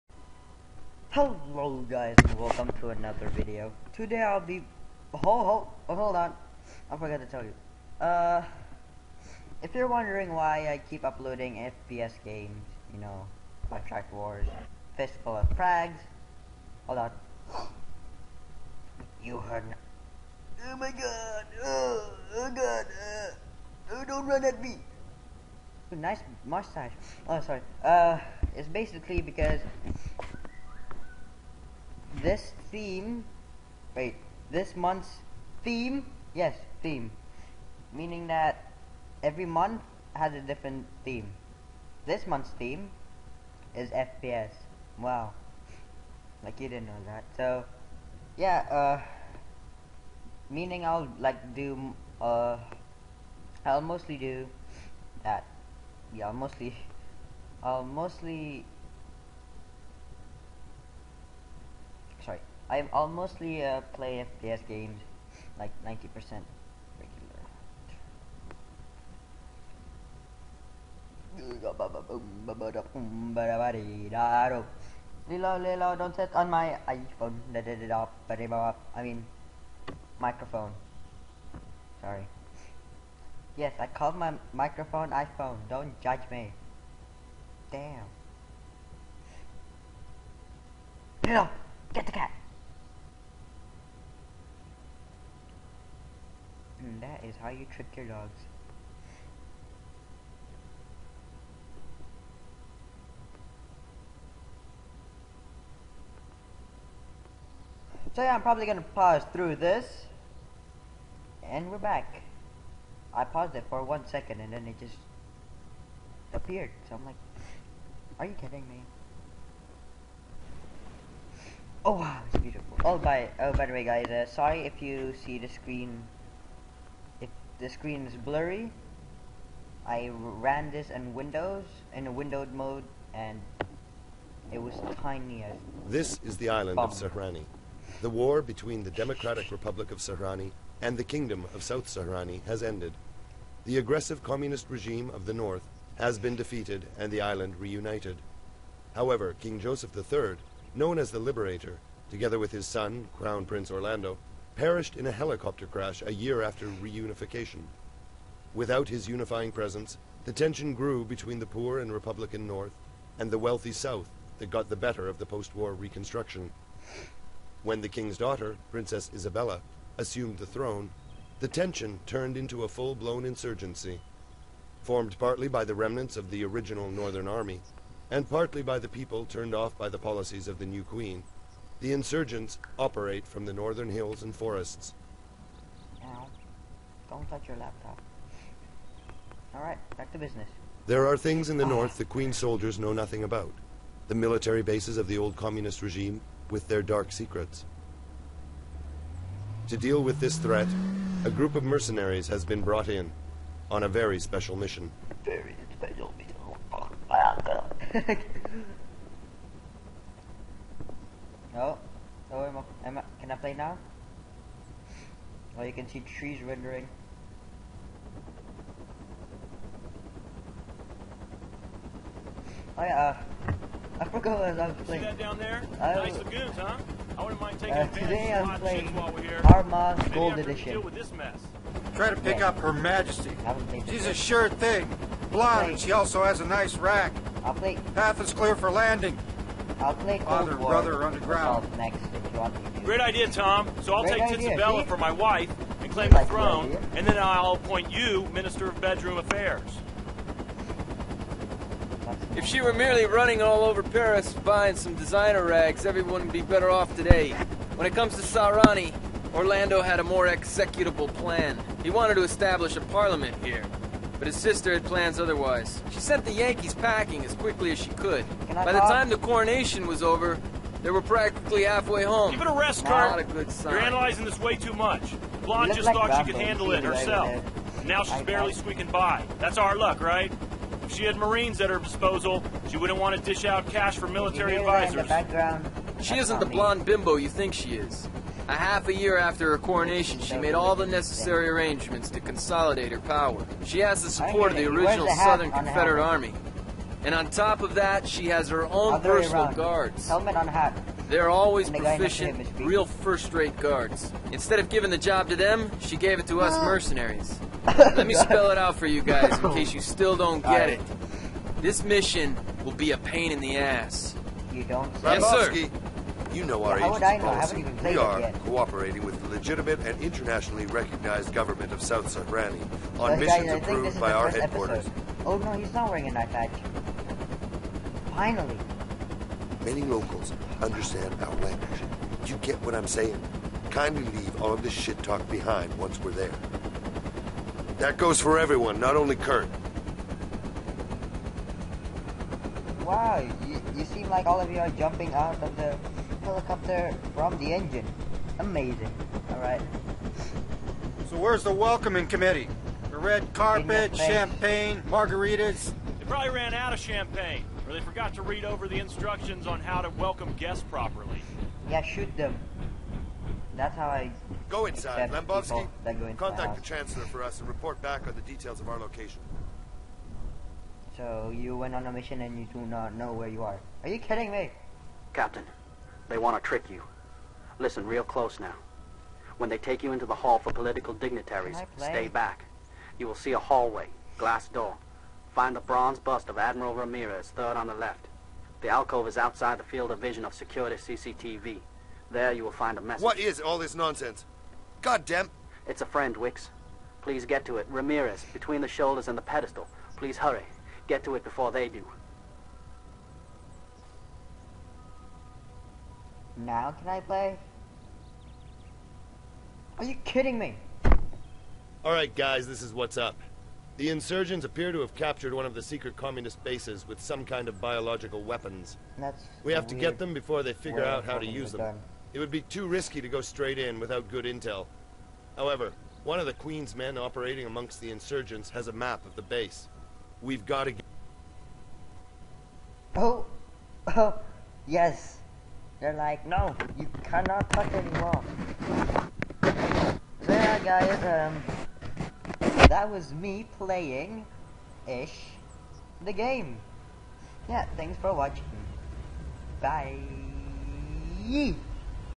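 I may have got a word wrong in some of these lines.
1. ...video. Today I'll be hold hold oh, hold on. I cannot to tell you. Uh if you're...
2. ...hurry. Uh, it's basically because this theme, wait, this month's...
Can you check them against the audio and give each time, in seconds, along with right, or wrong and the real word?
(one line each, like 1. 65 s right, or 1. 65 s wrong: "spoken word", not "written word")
1. 3 s wrong: "forgot", not "cannot"
2. 27 s wrong: "sorry", not "hurry".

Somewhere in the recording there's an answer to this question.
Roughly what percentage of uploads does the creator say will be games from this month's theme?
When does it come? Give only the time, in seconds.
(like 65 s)
65 s.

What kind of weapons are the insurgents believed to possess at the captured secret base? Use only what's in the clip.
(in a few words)
biological weapons.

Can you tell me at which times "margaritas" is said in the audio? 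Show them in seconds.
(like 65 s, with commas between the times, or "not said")
354 s.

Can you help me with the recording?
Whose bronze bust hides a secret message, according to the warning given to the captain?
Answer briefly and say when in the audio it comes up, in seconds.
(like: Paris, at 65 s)
Admiral Ramirez, at 386 s.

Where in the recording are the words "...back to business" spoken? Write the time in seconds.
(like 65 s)
189 s.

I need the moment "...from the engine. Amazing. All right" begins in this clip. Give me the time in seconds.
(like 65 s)
347 s.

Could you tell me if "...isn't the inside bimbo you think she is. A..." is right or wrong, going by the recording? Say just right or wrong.
wrong.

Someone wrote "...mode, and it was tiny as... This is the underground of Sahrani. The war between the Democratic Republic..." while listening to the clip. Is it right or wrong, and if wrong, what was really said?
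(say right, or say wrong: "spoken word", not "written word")
wrong: "island", not "underground".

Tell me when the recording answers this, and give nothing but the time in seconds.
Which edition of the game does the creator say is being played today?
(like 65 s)
228 s.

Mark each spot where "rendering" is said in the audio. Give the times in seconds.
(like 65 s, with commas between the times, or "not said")
216 s.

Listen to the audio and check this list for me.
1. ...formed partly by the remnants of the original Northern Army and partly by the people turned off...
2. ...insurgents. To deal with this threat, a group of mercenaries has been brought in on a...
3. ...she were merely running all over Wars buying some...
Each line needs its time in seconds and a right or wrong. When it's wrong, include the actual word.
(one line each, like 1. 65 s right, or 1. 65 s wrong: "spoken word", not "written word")
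1. 174 s right
2. 197 s wrong: "secrets", not "insurgents"
3. 252 s wrong: "Paris", not "Wars".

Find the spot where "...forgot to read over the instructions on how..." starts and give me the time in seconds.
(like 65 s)
357 s.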